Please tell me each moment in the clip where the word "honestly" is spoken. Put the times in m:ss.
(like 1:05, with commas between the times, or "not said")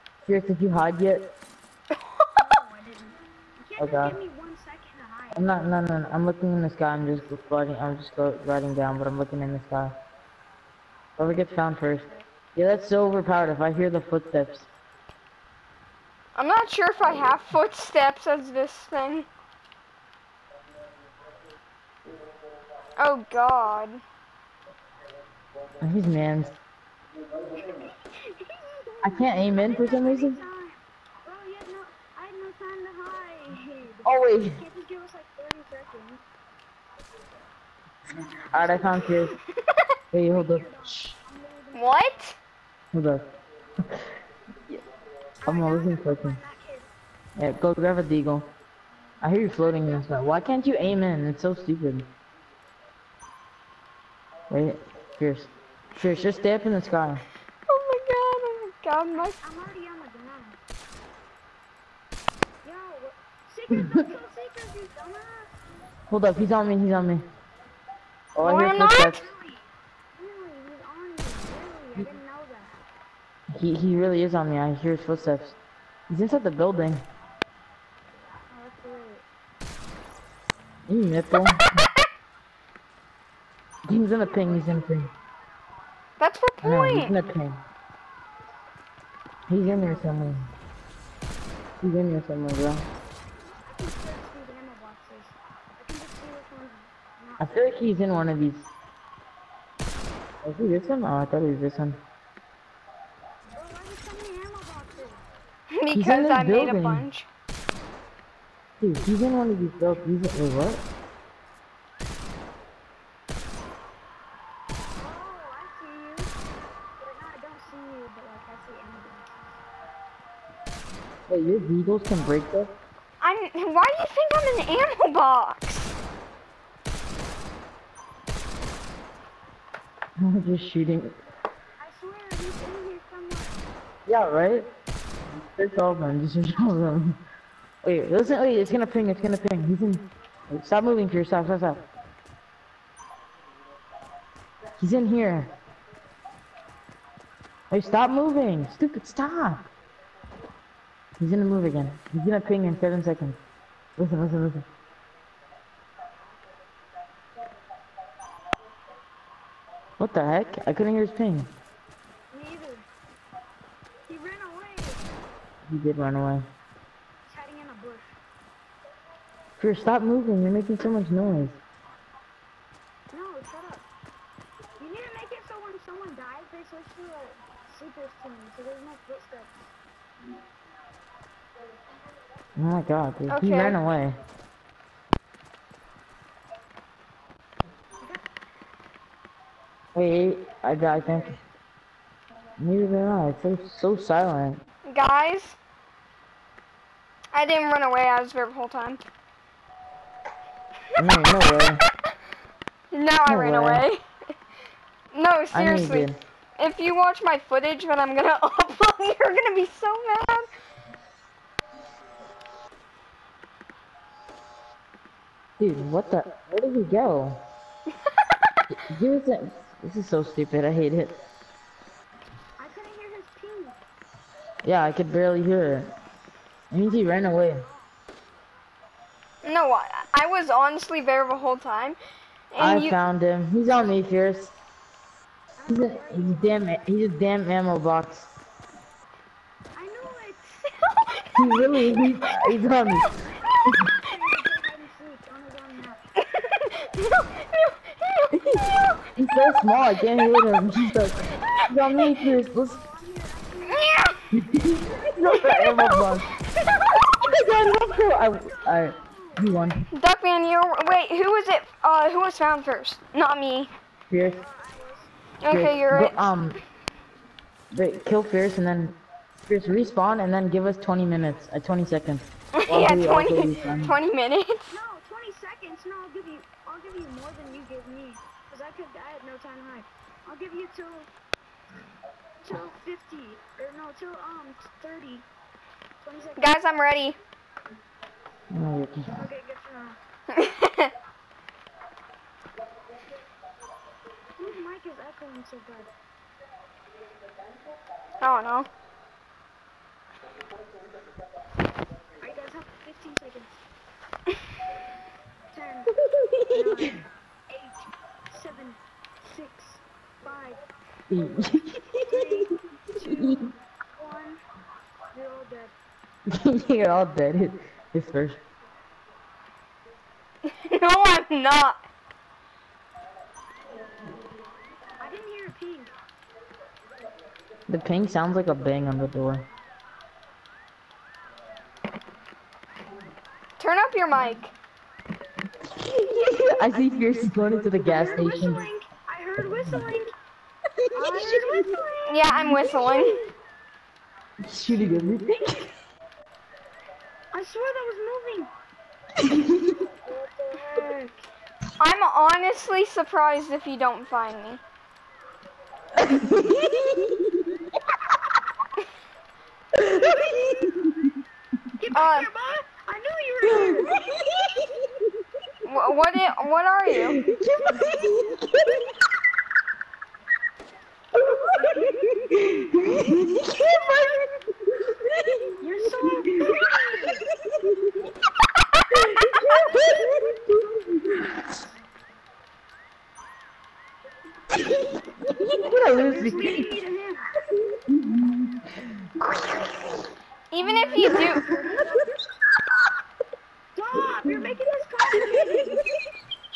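3:50, 5:52.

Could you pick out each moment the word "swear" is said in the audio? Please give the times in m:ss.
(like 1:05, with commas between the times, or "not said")
2:11, 5:47.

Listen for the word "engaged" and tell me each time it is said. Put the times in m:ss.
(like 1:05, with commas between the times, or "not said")
not said.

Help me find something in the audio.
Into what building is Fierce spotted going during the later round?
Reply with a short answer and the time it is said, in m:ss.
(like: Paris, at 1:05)
gas station, at 5:37.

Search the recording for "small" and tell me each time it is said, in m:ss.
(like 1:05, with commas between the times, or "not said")
4:09.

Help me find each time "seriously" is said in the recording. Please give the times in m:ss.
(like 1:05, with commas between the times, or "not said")
3:25.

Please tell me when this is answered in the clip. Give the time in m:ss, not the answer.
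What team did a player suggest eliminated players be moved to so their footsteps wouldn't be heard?
2:57.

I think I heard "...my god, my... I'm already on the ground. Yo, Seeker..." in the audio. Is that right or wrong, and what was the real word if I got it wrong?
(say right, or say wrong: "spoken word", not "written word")
right.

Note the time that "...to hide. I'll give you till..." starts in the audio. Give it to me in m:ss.
4:39.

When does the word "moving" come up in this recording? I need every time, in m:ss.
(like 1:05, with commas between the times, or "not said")
2:20, 2:28, 2:50, 5:49.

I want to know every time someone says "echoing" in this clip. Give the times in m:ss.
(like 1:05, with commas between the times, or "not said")
4:55.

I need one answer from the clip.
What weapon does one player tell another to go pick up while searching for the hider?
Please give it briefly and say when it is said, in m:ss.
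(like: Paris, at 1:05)
deagle, at 0:48.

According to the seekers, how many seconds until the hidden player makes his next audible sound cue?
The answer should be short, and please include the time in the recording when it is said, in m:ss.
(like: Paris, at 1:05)
7, at 2:32.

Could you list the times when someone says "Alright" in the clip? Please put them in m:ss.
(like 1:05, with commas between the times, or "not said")
0:38, 5:02.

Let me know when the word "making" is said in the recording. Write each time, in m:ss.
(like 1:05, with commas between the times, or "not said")
2:50.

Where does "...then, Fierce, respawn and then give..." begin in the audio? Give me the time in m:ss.
4:28.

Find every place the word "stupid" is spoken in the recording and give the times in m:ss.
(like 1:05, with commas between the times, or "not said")
0:51, 2:28, 3:40.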